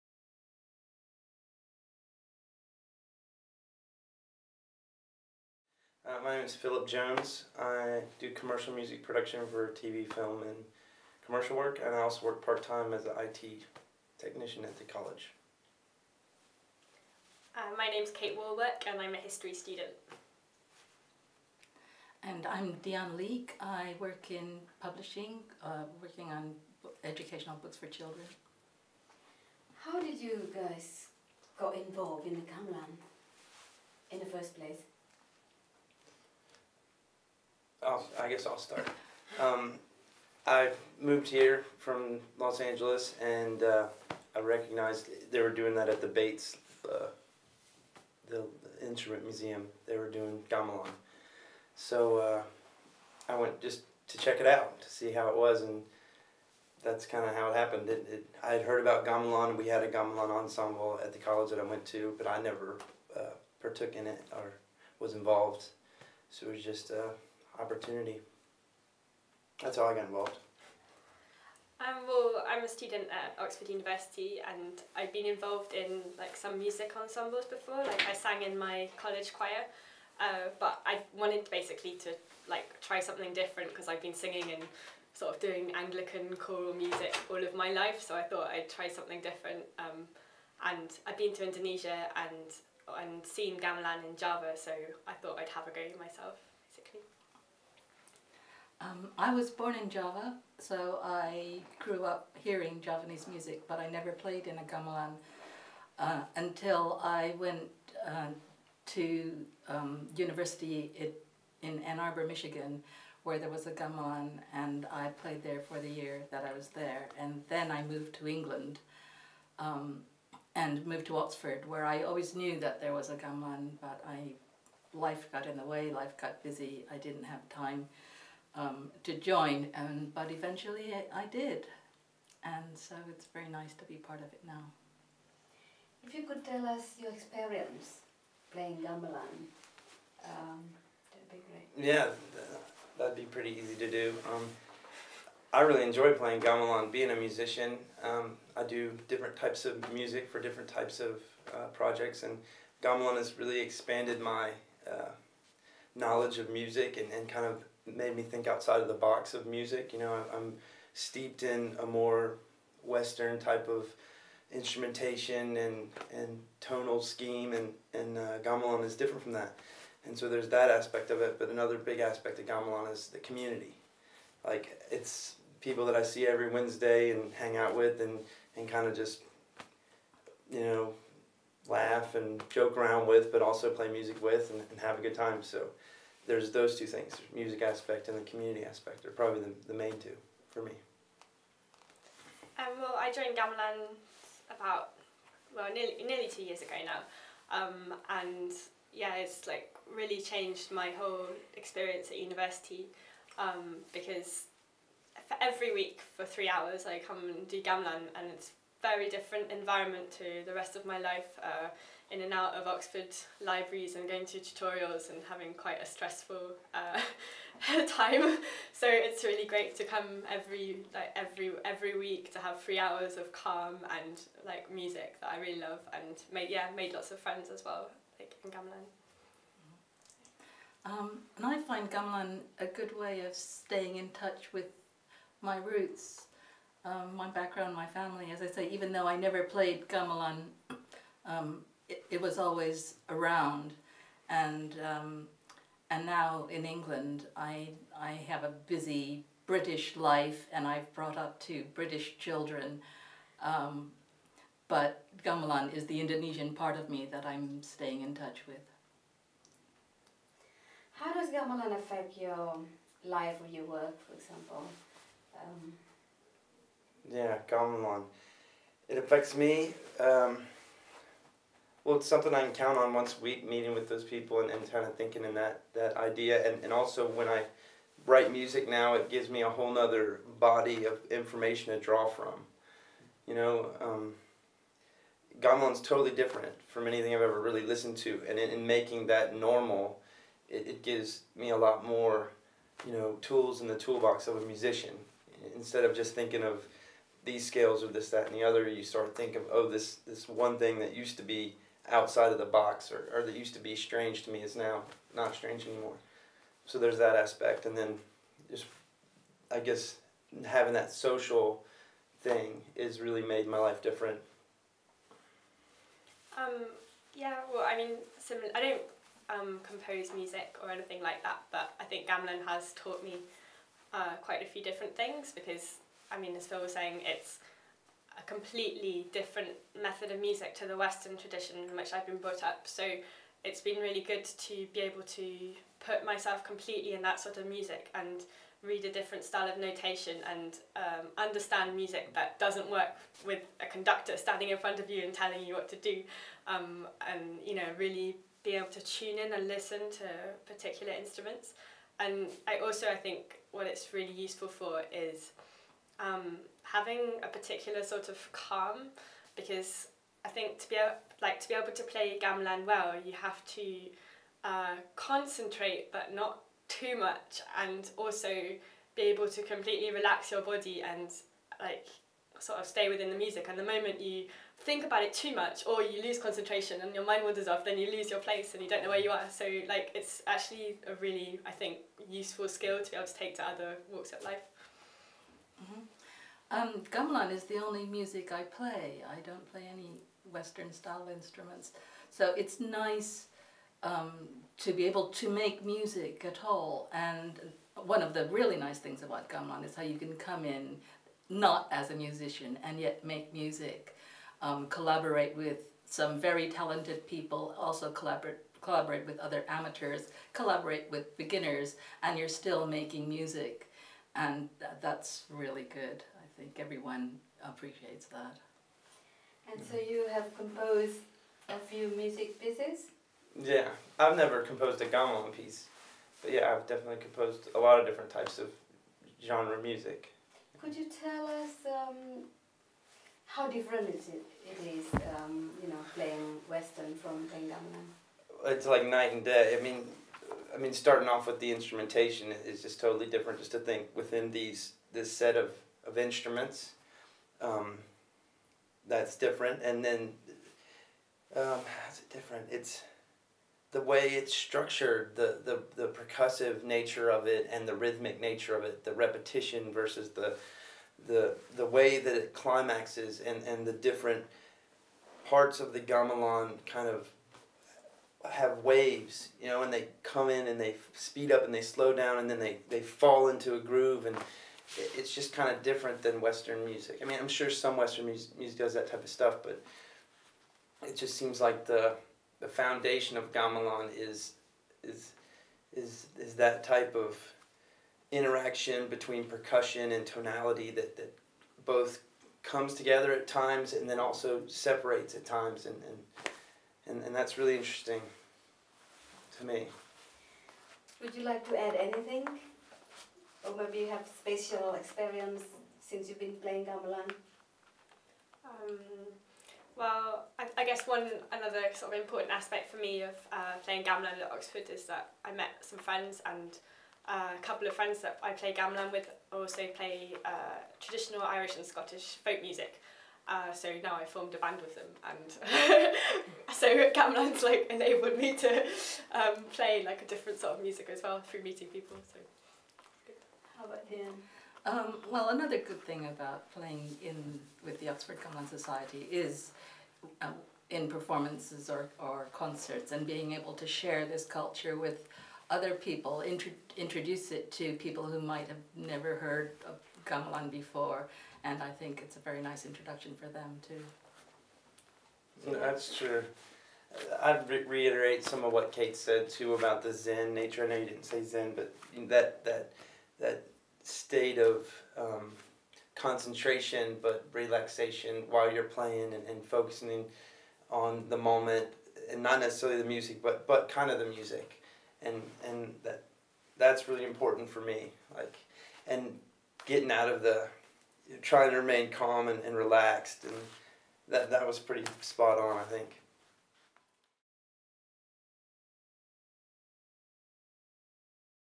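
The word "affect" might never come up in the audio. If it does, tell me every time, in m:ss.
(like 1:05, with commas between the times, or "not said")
4:21, 4:28.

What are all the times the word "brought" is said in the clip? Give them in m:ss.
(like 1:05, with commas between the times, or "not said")
4:10, 5:32.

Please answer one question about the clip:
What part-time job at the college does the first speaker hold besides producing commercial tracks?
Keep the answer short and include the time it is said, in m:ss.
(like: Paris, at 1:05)
IT technician, at 0:13.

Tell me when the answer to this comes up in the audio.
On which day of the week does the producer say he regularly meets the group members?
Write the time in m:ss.
2:56.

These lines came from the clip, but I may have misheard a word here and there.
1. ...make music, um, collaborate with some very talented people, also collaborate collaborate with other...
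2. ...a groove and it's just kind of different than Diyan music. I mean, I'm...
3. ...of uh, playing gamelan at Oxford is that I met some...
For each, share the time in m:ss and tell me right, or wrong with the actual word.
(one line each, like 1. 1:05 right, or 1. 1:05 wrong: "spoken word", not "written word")
1. 6:43 right
2. 7:53 wrong: "Western", not "Diyan"
3. 8:33 right.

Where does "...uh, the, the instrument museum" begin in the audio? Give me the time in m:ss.
0:46.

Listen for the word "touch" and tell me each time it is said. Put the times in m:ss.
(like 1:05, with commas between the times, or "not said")
3:54, 4:18.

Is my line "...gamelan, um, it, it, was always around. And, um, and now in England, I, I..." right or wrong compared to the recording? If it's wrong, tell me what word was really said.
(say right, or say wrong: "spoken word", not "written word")
right.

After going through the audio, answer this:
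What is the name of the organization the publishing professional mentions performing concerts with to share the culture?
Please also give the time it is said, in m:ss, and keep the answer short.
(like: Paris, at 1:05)
Oxford Gamelan Society, at 8:57.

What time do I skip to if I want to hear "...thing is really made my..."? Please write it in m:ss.
5:12.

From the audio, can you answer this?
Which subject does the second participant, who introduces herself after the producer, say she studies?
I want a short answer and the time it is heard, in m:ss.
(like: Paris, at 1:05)
History, at 0:19.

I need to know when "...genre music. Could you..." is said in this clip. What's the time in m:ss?
7:09.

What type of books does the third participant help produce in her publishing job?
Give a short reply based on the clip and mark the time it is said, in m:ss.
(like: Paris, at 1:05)
Educational books for children, at 0:27.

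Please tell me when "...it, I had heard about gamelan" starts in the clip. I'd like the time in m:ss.
0:58.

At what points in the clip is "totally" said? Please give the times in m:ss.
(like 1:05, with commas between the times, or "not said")
4:45, 7:22.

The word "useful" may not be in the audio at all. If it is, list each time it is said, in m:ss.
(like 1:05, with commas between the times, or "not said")
5:54, 6:22.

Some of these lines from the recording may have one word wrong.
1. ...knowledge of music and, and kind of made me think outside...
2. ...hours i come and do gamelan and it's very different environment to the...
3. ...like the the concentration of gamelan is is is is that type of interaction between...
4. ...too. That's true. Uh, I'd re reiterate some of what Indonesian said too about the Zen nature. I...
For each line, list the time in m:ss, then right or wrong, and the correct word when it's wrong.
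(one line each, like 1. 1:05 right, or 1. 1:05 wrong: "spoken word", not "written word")
1. 2:35 right
2. 3:26 right
3. 8:01 wrong: "foundation", not "concentration"
4. 9:13 wrong: "Kate", not "Indonesian".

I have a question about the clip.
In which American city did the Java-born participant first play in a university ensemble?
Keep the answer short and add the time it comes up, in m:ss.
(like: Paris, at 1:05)
Ann Arbor, at 1:51.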